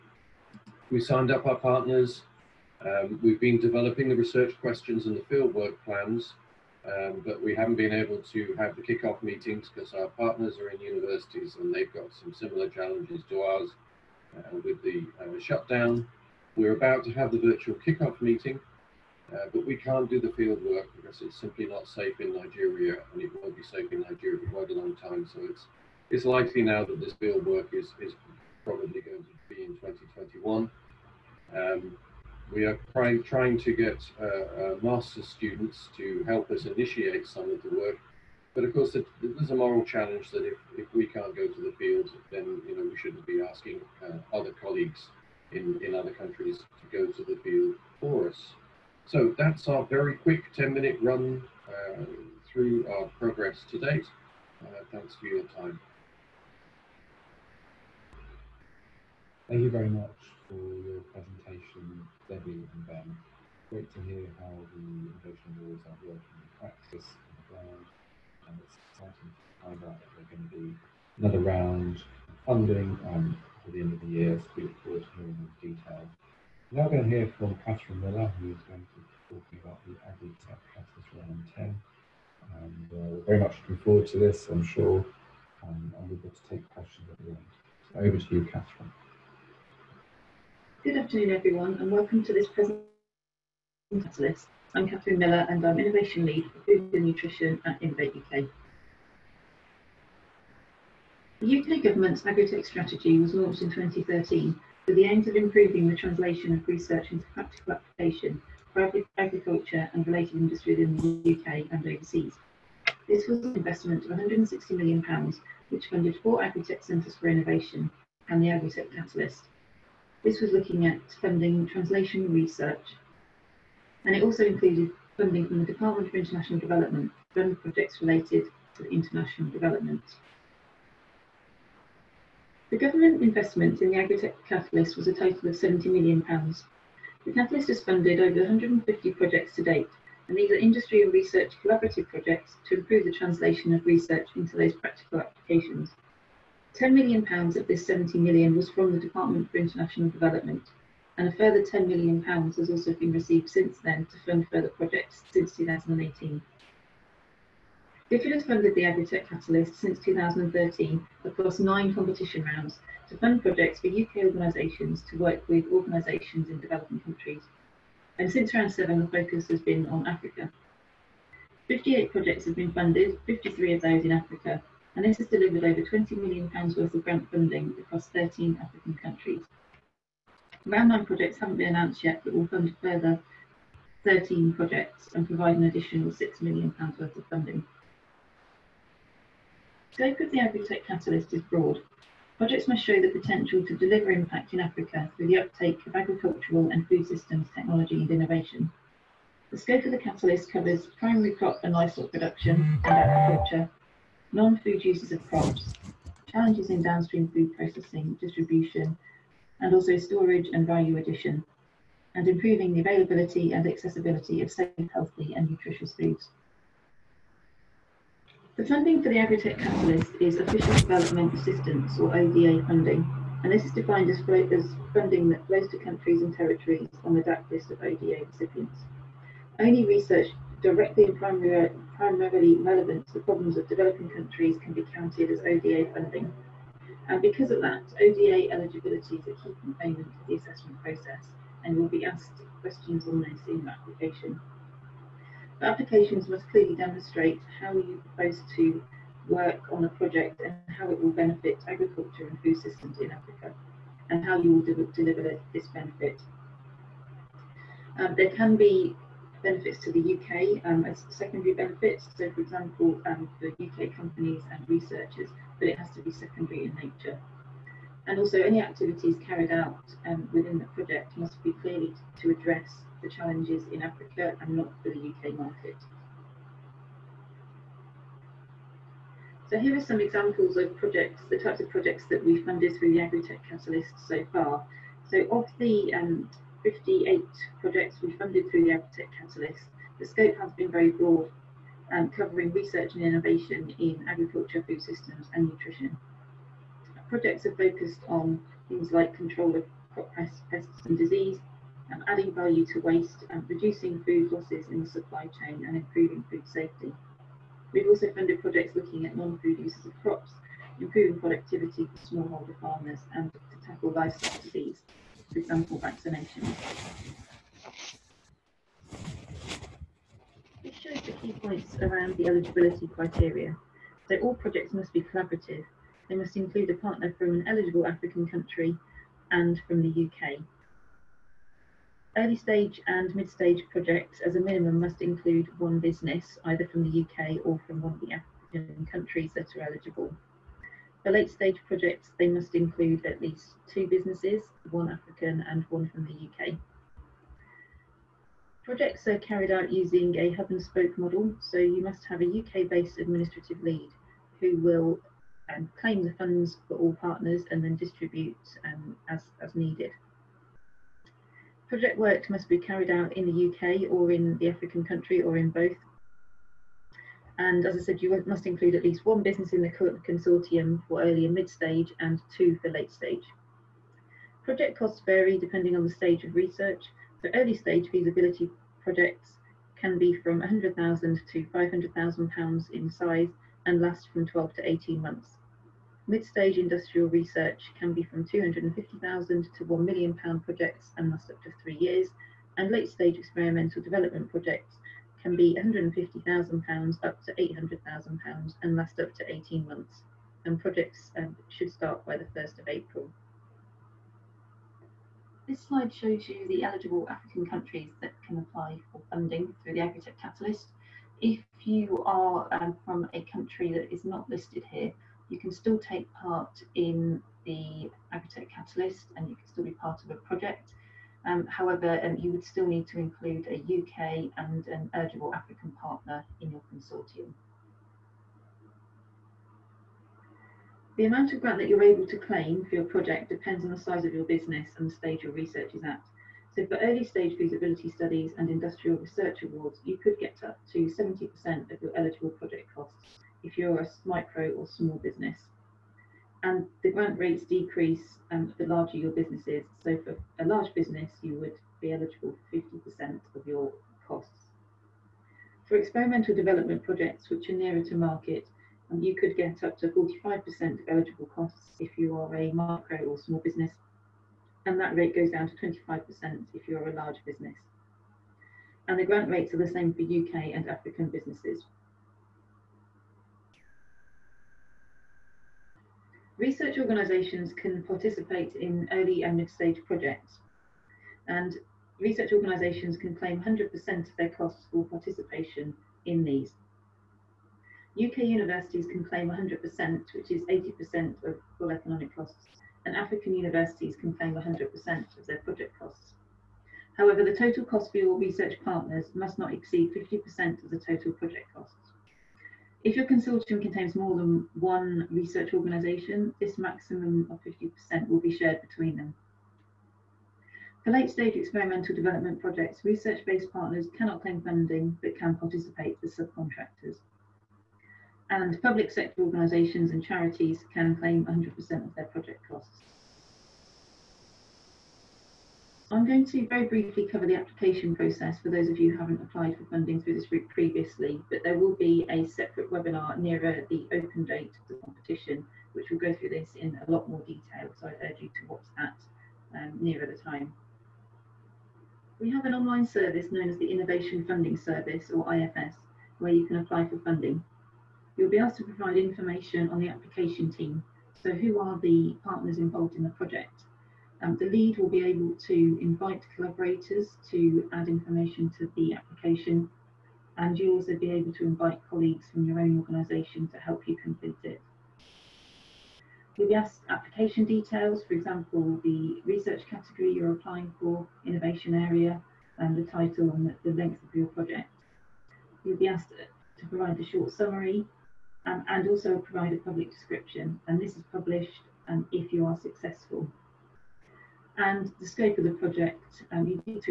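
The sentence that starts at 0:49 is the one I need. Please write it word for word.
So that's our very quick 10 minute run uh, through our progress to date.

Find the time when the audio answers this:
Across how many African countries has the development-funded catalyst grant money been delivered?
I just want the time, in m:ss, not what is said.
2:58.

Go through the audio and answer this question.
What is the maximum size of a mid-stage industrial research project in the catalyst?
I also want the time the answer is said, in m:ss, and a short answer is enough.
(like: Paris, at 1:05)
£1 million, at 6:29.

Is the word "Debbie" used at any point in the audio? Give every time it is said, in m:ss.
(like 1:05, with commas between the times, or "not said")
1:02.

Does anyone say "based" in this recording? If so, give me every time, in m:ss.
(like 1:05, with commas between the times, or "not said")
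5:52, 8:33.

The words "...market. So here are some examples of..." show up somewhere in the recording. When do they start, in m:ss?
4:35.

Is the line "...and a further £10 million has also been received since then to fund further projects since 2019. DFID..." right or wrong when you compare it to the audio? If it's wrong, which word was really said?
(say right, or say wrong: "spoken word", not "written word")
wrong: "2018", not "2019".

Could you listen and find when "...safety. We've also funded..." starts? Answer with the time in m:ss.
5:06.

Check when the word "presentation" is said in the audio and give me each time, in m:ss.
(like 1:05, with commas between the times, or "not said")
1:01, 1:32.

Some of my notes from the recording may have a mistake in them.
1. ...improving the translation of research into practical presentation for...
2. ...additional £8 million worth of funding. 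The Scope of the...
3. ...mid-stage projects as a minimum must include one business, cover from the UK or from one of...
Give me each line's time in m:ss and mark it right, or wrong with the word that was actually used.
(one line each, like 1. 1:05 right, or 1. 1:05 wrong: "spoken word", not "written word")
1. 1:45 wrong: "application", not "presentation"
2. 3:05 wrong: "6", not "8"
3. 5:33 wrong: "either", not "cover".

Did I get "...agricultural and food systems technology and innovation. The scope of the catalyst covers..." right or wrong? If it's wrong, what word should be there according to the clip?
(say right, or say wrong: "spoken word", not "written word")
right.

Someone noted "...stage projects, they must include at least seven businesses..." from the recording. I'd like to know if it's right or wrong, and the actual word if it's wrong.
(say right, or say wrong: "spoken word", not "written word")
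wrong: "two", not "seven".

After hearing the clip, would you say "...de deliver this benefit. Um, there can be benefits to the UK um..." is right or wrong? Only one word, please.
right.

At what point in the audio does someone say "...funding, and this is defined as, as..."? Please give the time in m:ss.
3:42.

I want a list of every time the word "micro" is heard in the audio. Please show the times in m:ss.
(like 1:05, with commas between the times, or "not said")
7:24, 7:42.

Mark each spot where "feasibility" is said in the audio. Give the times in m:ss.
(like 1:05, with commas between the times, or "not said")
6:17, 7:17.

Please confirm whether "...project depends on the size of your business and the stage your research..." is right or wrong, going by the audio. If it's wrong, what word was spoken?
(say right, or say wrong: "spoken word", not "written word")
right.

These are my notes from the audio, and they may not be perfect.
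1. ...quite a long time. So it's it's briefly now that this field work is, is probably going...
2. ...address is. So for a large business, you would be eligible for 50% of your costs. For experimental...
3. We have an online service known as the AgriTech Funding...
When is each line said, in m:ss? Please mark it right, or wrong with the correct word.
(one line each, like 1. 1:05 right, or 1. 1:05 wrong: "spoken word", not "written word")
1. 0:24 wrong: "likely", not "briefly"
2. 7:29 wrong: "business", not "address"
3. 9:02 wrong: "Innovation", not "AgriTech".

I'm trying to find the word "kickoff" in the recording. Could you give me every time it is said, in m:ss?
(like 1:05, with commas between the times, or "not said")
0:08, 0:17.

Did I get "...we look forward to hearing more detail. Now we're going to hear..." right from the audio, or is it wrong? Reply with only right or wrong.
right.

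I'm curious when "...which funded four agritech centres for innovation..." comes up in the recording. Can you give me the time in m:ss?
1:55.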